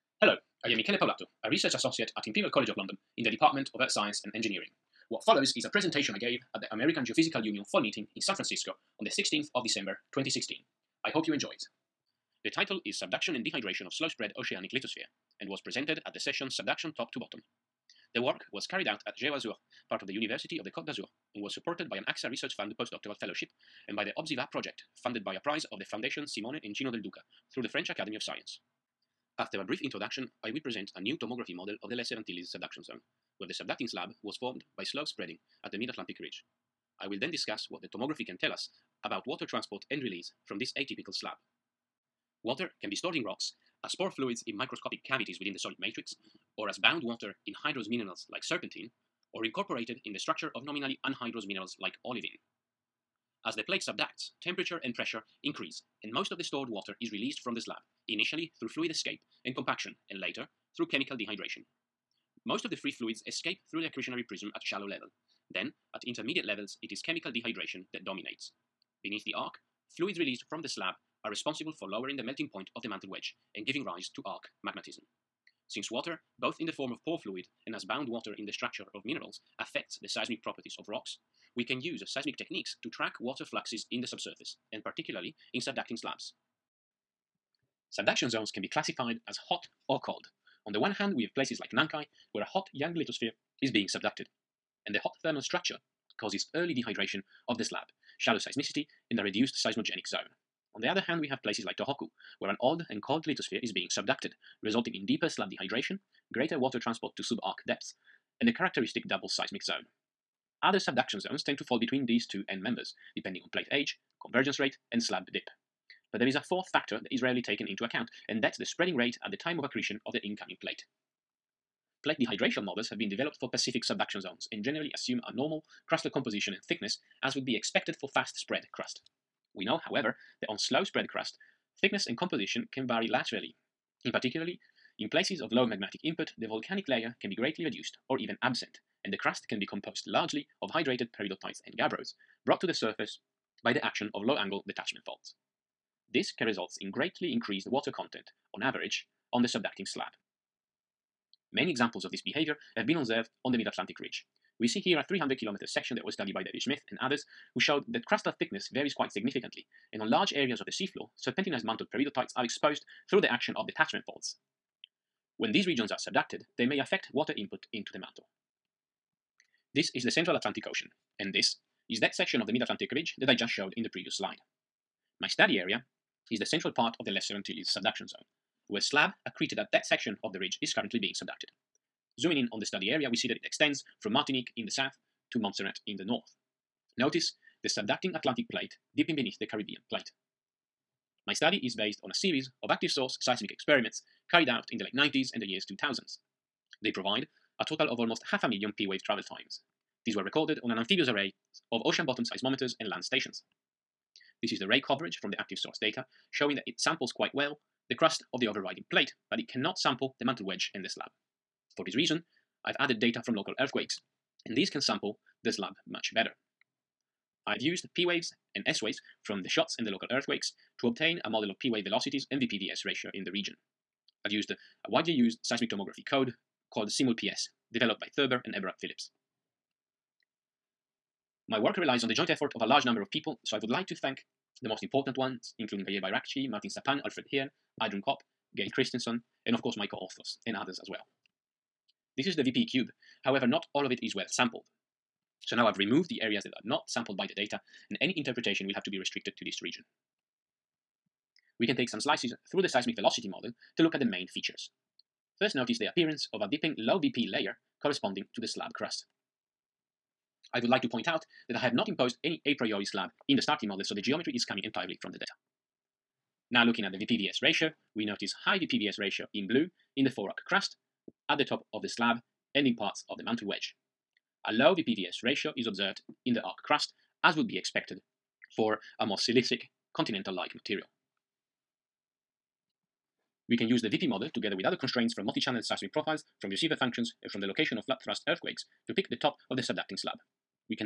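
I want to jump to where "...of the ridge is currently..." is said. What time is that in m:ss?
3:00.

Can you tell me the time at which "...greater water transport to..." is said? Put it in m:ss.
1:46.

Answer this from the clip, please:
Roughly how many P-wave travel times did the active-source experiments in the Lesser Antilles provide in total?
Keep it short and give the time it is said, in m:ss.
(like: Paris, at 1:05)
Almost half a million, at 3:17.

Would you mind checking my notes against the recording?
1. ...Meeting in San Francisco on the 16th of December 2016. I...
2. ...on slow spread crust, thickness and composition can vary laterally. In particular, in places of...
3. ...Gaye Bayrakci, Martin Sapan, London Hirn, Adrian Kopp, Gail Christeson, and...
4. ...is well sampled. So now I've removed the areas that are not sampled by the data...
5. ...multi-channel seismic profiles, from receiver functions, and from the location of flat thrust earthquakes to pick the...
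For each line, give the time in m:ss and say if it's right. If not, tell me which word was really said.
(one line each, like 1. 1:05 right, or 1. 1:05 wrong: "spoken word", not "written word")
1. 0:07 right
2. 2:10 right
3. 3:55 wrong: "Alfred", not "London"
4. 4:04 right
5. 4:45 right.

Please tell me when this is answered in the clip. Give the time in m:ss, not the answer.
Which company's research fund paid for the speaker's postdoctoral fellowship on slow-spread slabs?
0:22.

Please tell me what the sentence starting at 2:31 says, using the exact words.
Many examples of this behavior have been observed on the Mid-Atlantic Ridge.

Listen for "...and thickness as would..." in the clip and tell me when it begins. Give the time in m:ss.
2:06.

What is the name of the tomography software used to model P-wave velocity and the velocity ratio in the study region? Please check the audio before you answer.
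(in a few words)
SIMUL-PS.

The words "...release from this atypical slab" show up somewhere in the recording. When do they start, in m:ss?
0:40.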